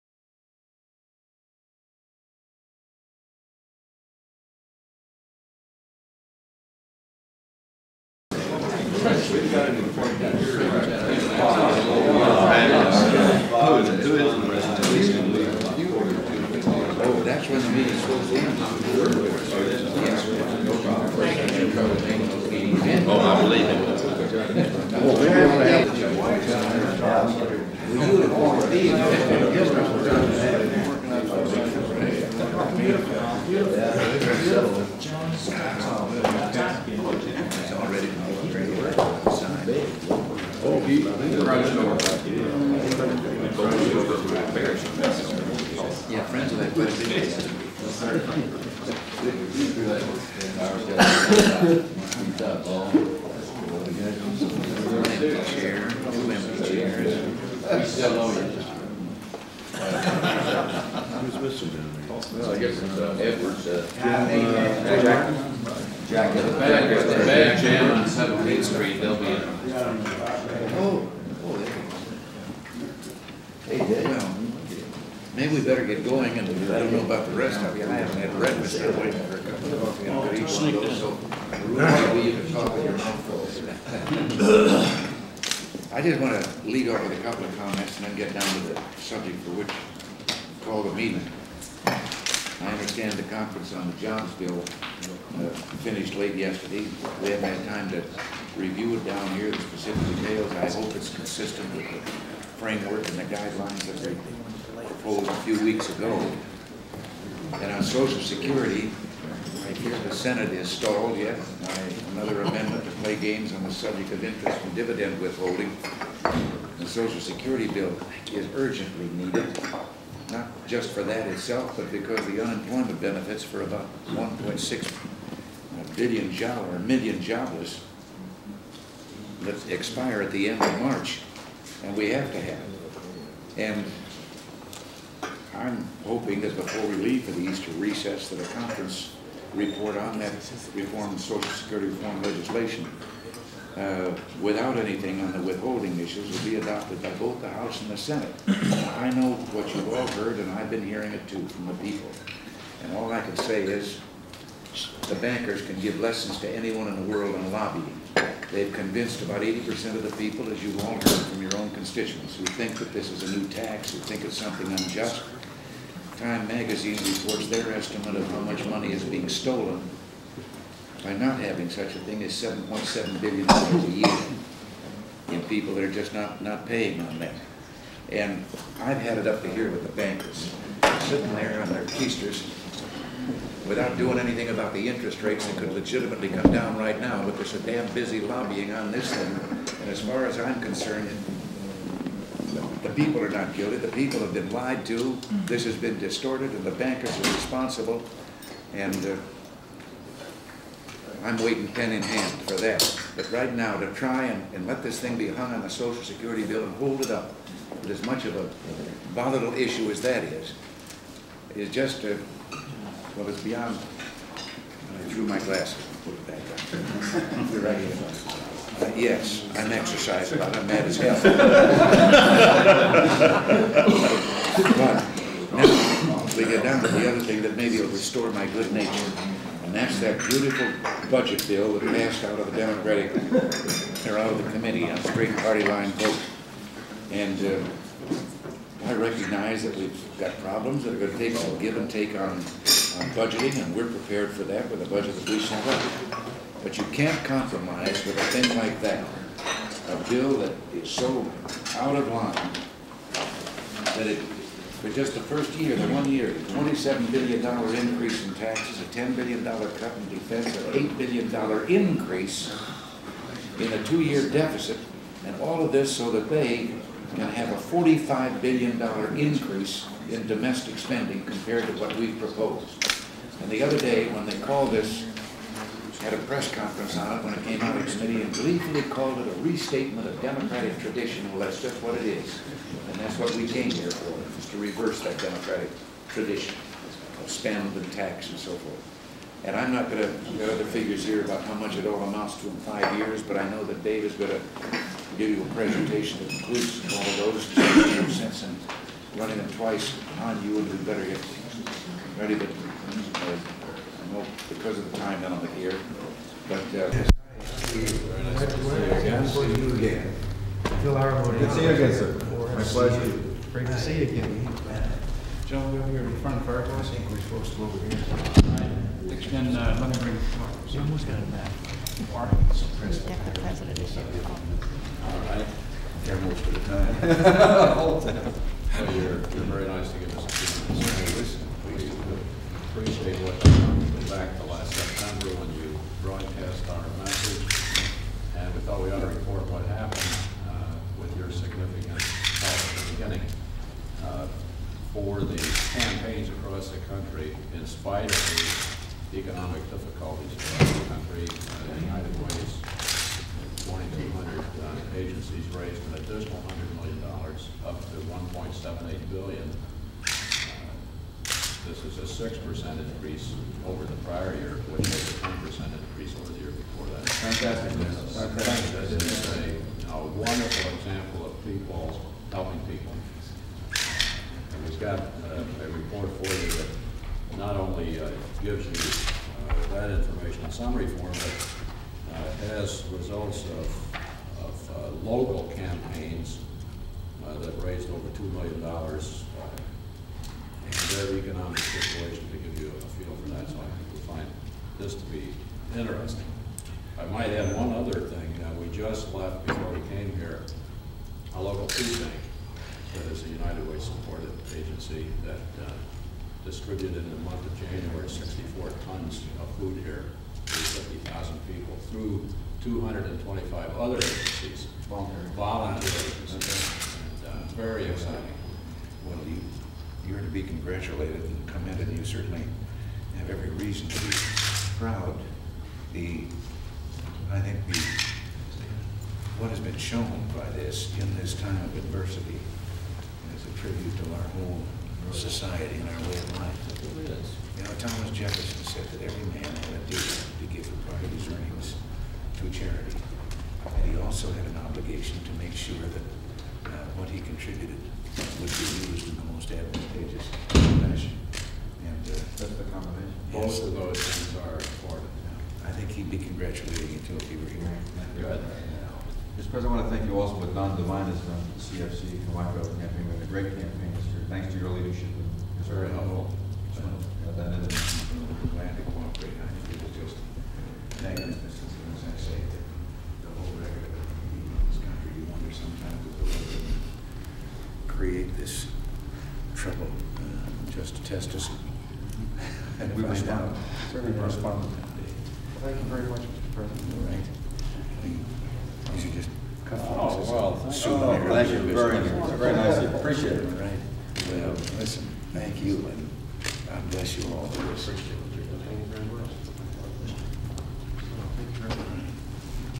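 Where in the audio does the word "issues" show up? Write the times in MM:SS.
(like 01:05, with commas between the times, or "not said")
02:25, 03:29.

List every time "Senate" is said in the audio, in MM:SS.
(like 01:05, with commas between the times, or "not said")
01:50, 02:27.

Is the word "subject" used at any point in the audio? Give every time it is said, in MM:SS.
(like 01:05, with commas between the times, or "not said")
01:28, 01:53.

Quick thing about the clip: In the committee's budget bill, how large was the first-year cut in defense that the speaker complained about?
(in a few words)
$10 billion.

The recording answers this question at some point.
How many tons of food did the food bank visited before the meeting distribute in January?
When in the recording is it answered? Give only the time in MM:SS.
06:48.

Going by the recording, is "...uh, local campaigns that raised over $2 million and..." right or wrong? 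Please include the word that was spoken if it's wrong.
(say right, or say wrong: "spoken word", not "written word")
right.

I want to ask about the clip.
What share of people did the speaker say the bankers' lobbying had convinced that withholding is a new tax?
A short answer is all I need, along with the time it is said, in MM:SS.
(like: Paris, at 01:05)
80%, at 02:39.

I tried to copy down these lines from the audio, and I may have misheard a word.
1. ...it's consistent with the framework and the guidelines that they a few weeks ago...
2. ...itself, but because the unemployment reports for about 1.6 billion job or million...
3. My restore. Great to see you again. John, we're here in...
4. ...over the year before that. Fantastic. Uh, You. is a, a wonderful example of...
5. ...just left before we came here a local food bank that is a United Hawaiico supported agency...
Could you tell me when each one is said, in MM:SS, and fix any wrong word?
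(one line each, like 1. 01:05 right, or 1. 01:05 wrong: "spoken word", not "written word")
1. 01:40 right
2. 02:01 wrong: "benefits", not "reports"
3. 05:12 wrong: "pleasure", not "restore"
4. 06:06 wrong: "Fantastic", not "You"
5. 06:38 wrong: "Way", not "Hawaiico".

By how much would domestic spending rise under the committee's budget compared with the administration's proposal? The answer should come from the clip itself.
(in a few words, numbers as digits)
$45 billion.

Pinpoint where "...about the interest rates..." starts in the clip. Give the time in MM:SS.
03:04.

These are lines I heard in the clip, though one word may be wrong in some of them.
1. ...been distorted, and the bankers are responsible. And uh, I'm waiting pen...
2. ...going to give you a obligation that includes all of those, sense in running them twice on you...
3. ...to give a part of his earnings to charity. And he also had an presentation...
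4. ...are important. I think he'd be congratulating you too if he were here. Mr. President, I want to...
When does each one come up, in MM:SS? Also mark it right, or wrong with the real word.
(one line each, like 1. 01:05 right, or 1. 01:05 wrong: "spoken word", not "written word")
1. 03:15 right
2. 04:54 wrong: "presentation", not "obligation"
3. 07:20 wrong: "obligation", not "presentation"
4. 07:34 right.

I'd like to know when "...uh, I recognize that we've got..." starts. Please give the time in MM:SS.
03:57.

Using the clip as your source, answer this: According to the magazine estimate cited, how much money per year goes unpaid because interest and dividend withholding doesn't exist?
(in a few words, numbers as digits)
$7.7 billion.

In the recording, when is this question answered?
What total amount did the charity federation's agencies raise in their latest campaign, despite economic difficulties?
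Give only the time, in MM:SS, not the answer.
05:58.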